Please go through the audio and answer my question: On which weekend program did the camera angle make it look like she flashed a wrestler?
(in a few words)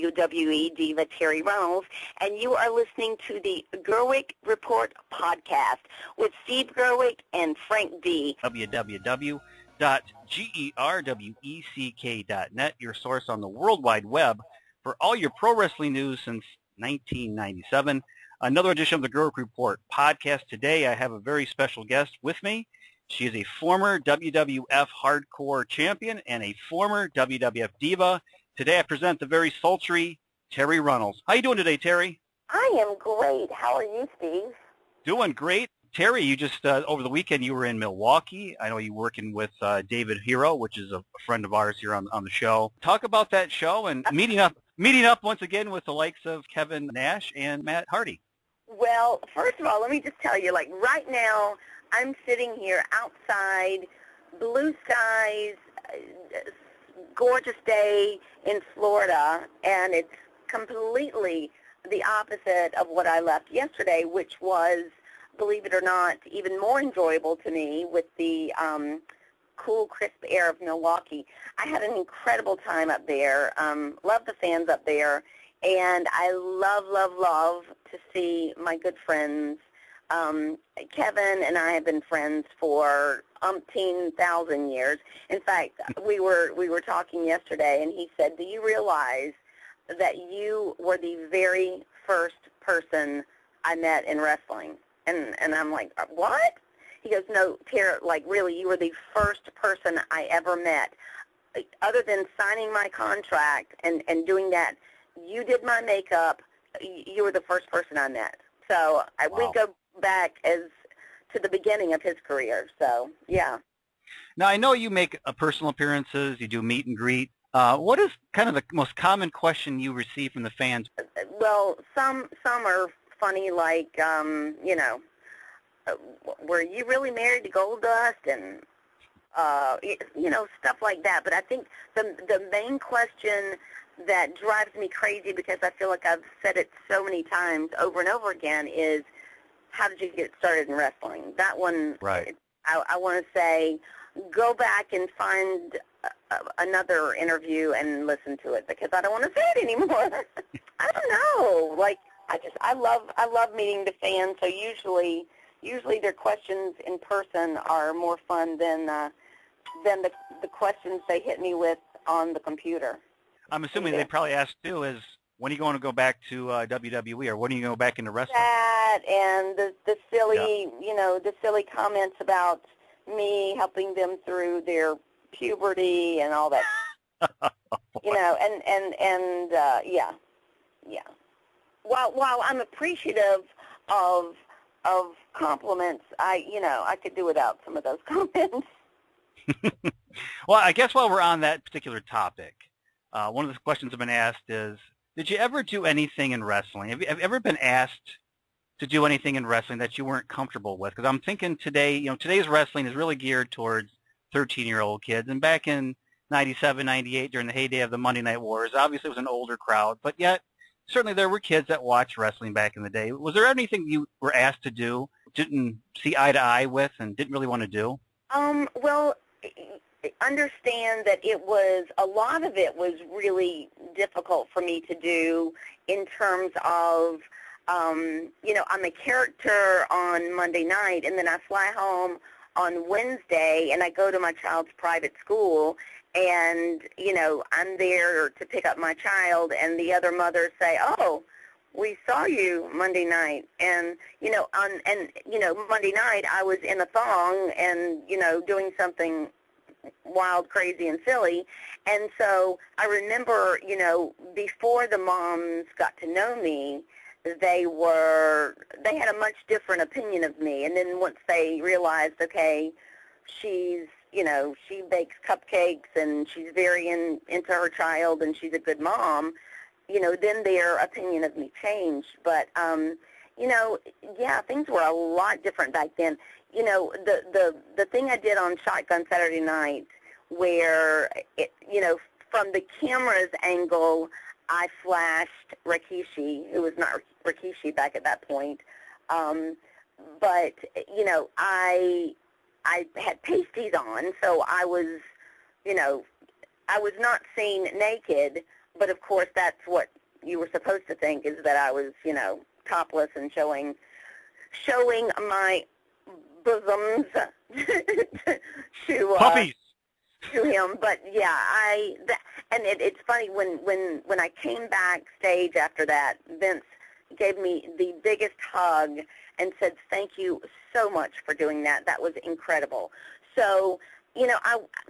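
Shotgun Saturday night.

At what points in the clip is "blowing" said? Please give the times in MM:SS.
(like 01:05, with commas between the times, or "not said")
not said.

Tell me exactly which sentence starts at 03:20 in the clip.
Because I'm thinking today, you know, today's wrestling is really geared towards 13-year-old kids.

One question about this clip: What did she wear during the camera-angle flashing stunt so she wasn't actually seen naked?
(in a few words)
Pasties.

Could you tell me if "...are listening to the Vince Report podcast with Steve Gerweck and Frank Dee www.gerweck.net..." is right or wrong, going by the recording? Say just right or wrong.
wrong.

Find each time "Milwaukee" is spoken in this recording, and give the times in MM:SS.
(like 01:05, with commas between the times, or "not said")
00:37, 01:10.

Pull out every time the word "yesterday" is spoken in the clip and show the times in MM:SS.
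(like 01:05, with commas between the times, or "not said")
01:03, 01:27.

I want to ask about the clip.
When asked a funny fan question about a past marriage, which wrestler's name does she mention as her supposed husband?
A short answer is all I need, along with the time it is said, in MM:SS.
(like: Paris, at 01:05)
Goldust, at 02:07.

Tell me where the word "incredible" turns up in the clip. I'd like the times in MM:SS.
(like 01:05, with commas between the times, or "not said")
01:11, 05:22.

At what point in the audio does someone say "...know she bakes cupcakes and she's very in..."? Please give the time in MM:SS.
04:24.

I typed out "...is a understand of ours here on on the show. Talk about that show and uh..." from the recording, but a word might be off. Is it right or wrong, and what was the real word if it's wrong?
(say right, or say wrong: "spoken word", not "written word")
wrong: "friend", not "understand".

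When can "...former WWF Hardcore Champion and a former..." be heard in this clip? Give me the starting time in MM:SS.
00:23.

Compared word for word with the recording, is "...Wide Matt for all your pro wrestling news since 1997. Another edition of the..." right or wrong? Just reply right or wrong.
wrong.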